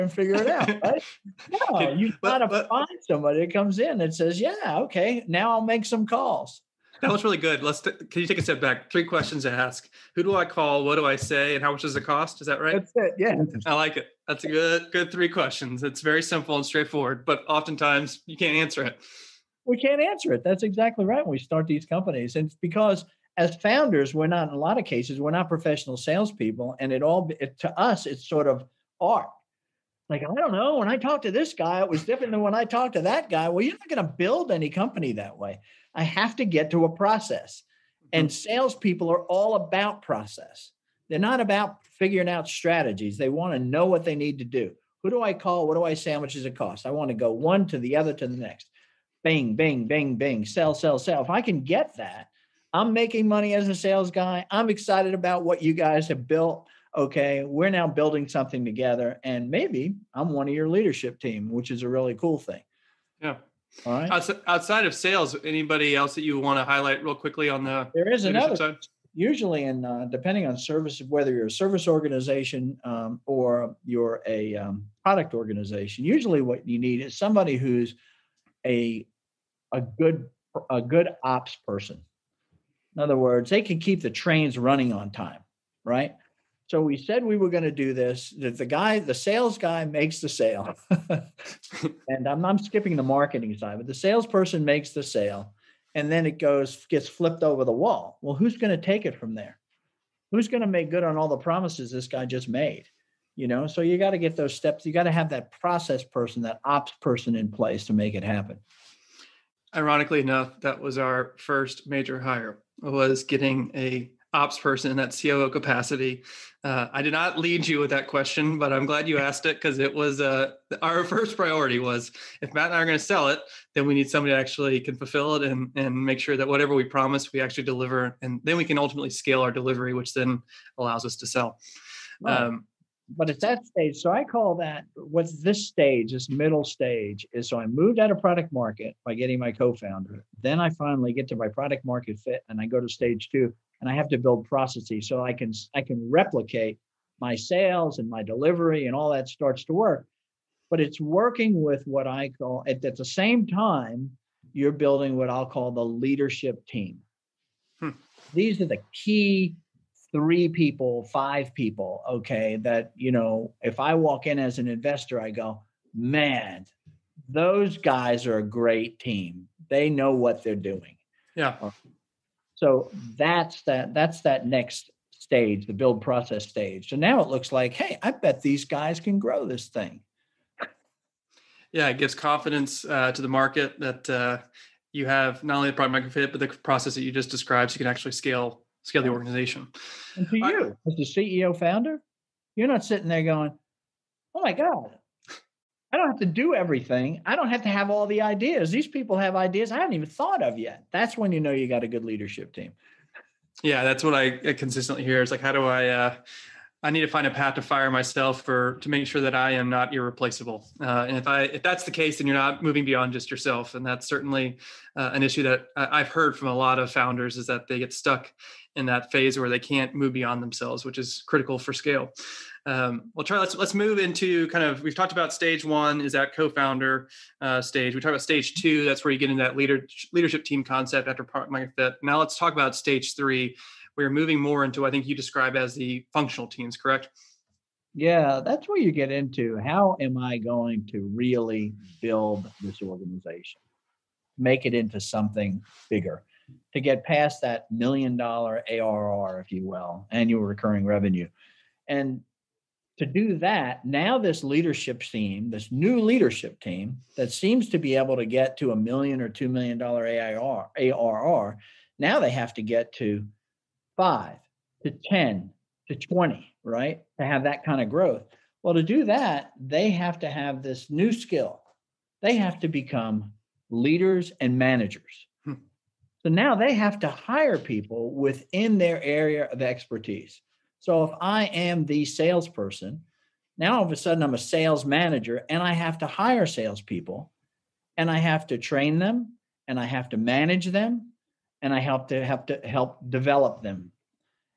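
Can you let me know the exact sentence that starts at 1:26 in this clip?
So we said we were going to do this.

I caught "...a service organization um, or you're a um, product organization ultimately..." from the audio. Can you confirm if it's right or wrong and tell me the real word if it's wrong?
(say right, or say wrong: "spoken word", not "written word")
wrong: "usually", not "ultimately".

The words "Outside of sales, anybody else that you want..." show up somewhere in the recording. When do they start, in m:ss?
1:04.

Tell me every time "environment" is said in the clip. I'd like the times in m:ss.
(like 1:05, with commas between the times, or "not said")
not said.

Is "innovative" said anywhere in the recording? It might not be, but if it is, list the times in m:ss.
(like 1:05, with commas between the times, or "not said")
not said.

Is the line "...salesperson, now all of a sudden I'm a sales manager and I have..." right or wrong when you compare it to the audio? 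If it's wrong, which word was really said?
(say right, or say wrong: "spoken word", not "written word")
right.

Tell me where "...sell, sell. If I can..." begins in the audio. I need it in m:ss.
0:50.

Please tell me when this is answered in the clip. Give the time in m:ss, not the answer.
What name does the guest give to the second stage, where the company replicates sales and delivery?
2:55.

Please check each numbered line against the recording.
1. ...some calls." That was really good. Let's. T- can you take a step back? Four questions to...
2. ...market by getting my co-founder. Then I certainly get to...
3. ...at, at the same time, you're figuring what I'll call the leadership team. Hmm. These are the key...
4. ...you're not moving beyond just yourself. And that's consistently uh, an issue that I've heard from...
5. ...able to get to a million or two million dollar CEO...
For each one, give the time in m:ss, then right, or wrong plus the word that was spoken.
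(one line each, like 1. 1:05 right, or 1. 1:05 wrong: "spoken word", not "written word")
1. 0:05 wrong: "Three", not "Four"
2. 2:18 wrong: "finally", not "certainly"
3. 2:32 wrong: "building", not "figuring"
4. 3:32 wrong: "certainly", not "consistently"
5. 4:17 wrong: "AIR", not "CEO".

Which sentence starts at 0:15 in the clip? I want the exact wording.
It's very simple and straightforward, but oftentimes you can't answer it.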